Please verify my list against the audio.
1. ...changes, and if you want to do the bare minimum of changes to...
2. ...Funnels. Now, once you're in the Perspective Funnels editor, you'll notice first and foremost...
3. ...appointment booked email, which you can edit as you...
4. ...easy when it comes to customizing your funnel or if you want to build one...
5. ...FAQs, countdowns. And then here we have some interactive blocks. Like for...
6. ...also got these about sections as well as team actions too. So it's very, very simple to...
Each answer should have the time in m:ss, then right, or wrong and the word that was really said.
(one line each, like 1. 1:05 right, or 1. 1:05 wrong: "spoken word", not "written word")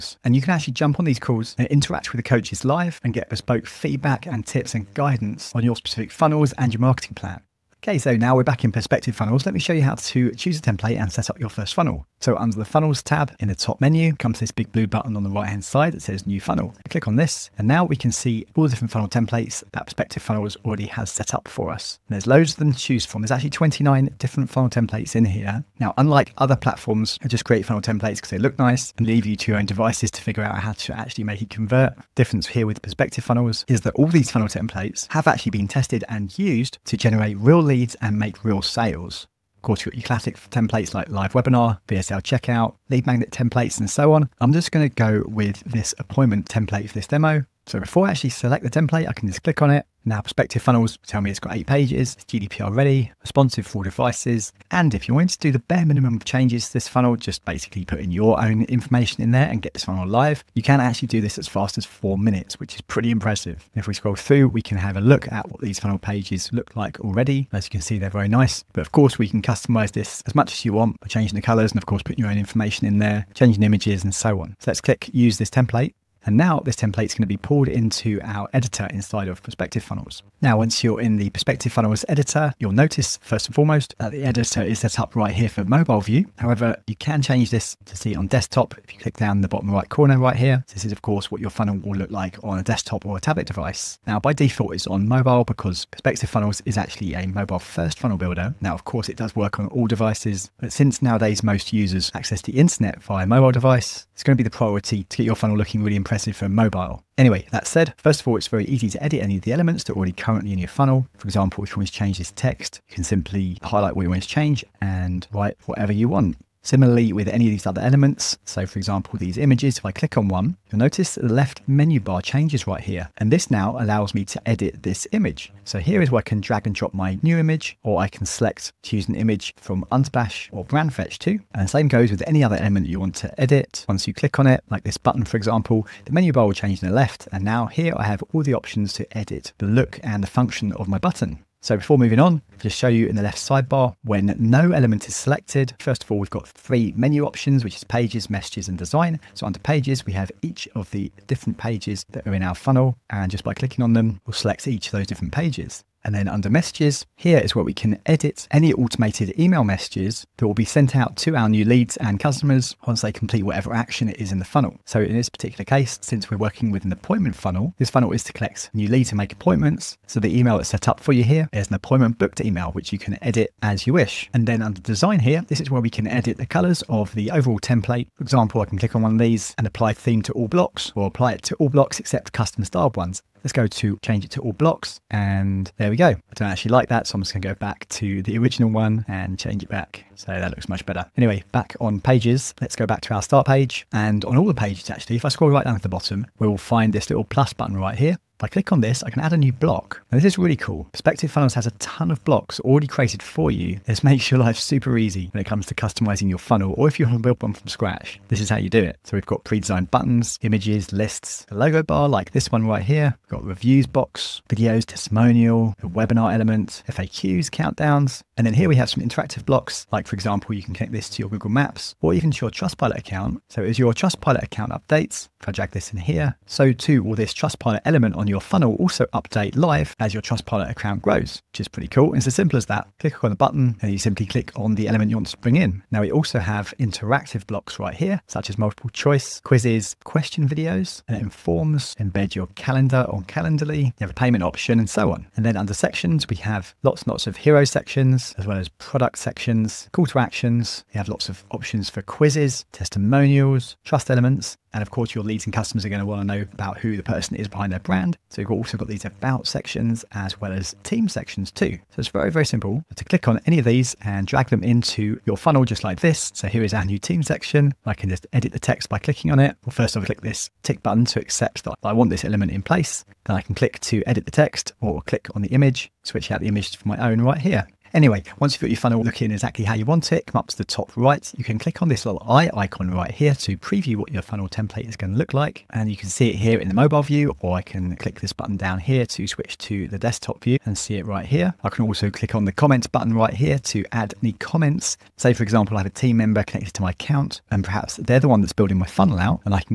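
1. 0:53 wrong: "devices", not "changes"
2. 1:19 right
3. 2:51 right
4. 3:24 right
5. 3:36 right
6. 4:18 wrong: "sections", not "actions".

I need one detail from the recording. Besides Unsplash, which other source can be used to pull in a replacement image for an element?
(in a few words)
Brandfetch.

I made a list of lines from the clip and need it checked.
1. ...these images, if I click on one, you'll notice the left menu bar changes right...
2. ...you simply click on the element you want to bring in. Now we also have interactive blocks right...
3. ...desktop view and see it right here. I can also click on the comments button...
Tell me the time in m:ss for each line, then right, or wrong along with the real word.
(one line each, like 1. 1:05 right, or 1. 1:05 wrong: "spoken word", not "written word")
1. 1:59 right
2. 3:53 right
3. 4:49 right.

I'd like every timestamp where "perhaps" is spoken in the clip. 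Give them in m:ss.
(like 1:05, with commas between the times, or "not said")
4:57.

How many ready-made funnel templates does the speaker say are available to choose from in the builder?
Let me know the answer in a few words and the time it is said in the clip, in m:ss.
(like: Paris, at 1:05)
29, at 0:23.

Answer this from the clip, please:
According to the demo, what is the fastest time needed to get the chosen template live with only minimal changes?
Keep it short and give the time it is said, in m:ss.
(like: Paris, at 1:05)
4 minutes, at 1:01.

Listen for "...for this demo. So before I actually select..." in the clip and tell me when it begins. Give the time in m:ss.
0:46.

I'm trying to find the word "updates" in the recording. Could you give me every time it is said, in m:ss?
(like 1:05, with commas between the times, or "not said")
3:44, 3:49.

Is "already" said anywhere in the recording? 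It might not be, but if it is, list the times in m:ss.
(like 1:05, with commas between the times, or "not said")
0:20, 1:07, 1:49, 3:22.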